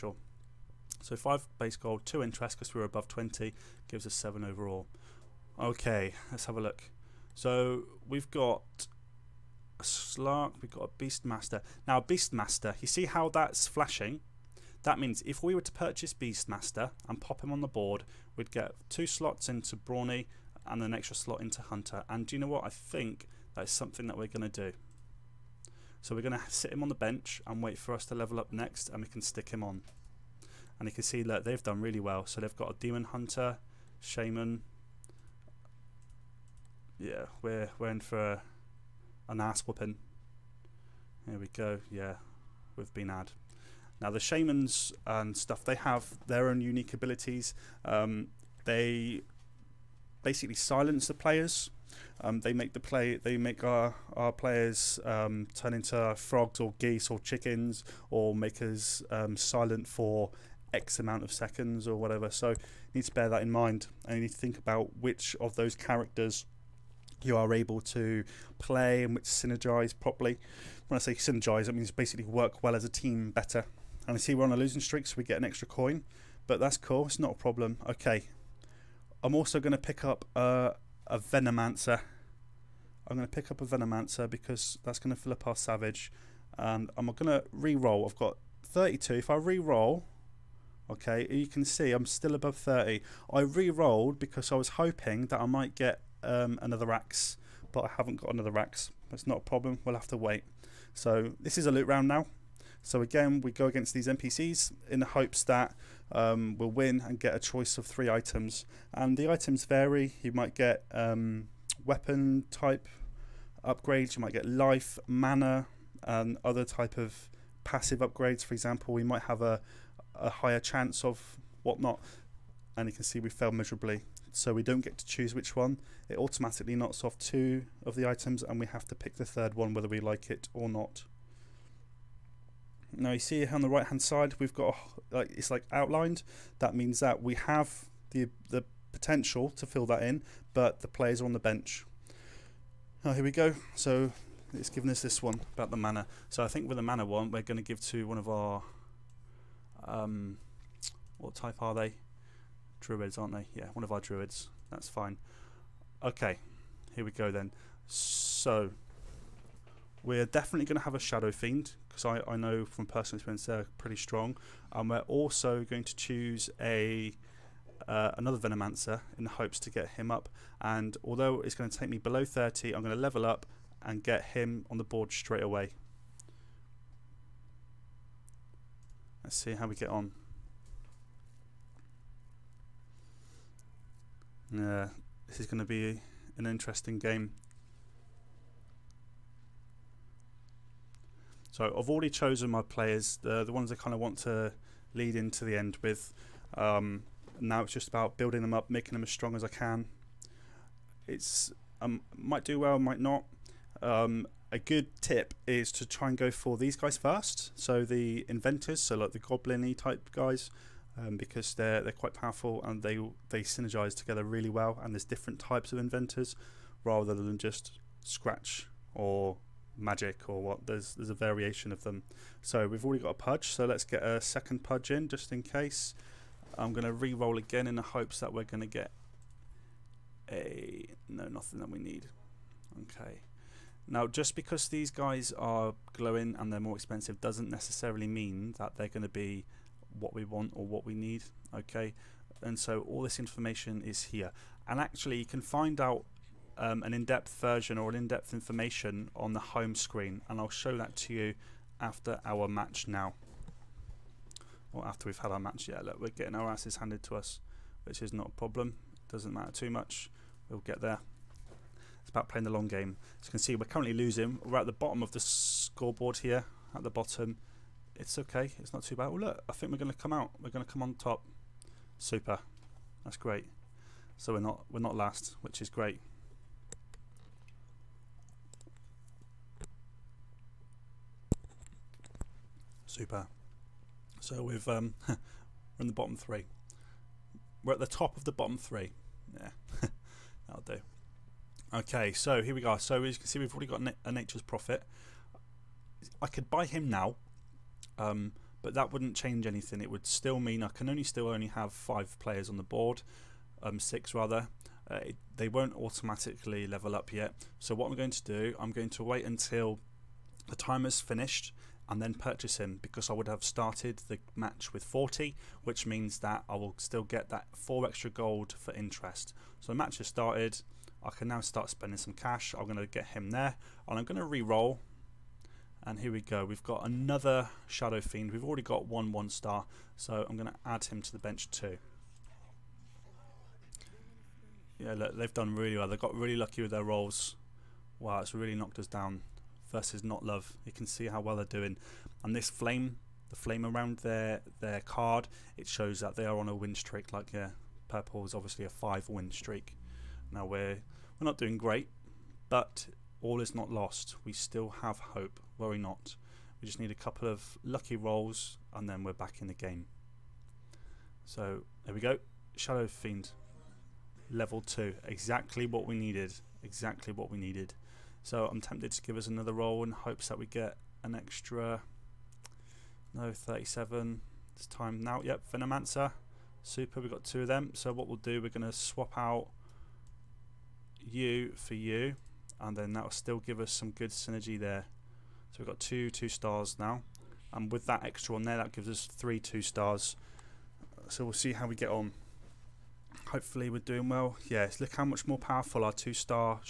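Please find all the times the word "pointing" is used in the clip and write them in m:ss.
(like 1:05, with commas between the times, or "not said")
not said.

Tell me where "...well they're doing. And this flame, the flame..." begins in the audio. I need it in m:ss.
5:41.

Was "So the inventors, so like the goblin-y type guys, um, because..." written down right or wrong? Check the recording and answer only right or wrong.
right.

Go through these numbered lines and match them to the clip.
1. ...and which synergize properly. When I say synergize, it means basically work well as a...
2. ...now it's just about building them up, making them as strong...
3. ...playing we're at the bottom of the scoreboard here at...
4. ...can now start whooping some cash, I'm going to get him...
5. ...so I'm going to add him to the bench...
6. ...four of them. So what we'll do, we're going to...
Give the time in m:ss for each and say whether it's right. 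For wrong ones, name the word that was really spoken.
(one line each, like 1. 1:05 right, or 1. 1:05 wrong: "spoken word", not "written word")
1. 1:09 right
2. 3:17 right
3. 4:23 wrong: "losing", not "playing"
4. 5:21 wrong: "spending", not "whooping"
5. 5:29 right
6. 6:17 wrong: "two", not "four".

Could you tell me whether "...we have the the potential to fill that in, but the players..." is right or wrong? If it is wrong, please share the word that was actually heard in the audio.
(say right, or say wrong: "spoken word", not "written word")
right.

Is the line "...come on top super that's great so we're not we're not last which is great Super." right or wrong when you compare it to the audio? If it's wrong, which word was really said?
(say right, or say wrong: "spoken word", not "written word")
right.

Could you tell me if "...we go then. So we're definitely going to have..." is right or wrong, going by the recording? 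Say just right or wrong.
right.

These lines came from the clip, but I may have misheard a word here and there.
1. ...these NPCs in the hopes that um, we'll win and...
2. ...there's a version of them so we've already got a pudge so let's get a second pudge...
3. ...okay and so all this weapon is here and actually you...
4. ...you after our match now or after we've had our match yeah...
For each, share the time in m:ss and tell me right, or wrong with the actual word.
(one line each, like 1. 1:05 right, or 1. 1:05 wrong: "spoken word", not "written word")
1. 1:43 right
2. 3:40 wrong: "variation", not "version"
3. 4:01 wrong: "information", not "weapon"
4. 4:11 right.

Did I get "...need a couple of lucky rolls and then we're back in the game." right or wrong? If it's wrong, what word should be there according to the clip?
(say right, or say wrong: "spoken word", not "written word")
right.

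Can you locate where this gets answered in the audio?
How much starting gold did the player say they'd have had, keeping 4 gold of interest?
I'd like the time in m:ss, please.
5:14.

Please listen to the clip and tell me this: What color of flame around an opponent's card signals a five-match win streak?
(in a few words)
purple.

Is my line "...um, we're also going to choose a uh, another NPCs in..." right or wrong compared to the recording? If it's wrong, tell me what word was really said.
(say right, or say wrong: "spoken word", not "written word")
wrong: "Venomancer", not "NPCs".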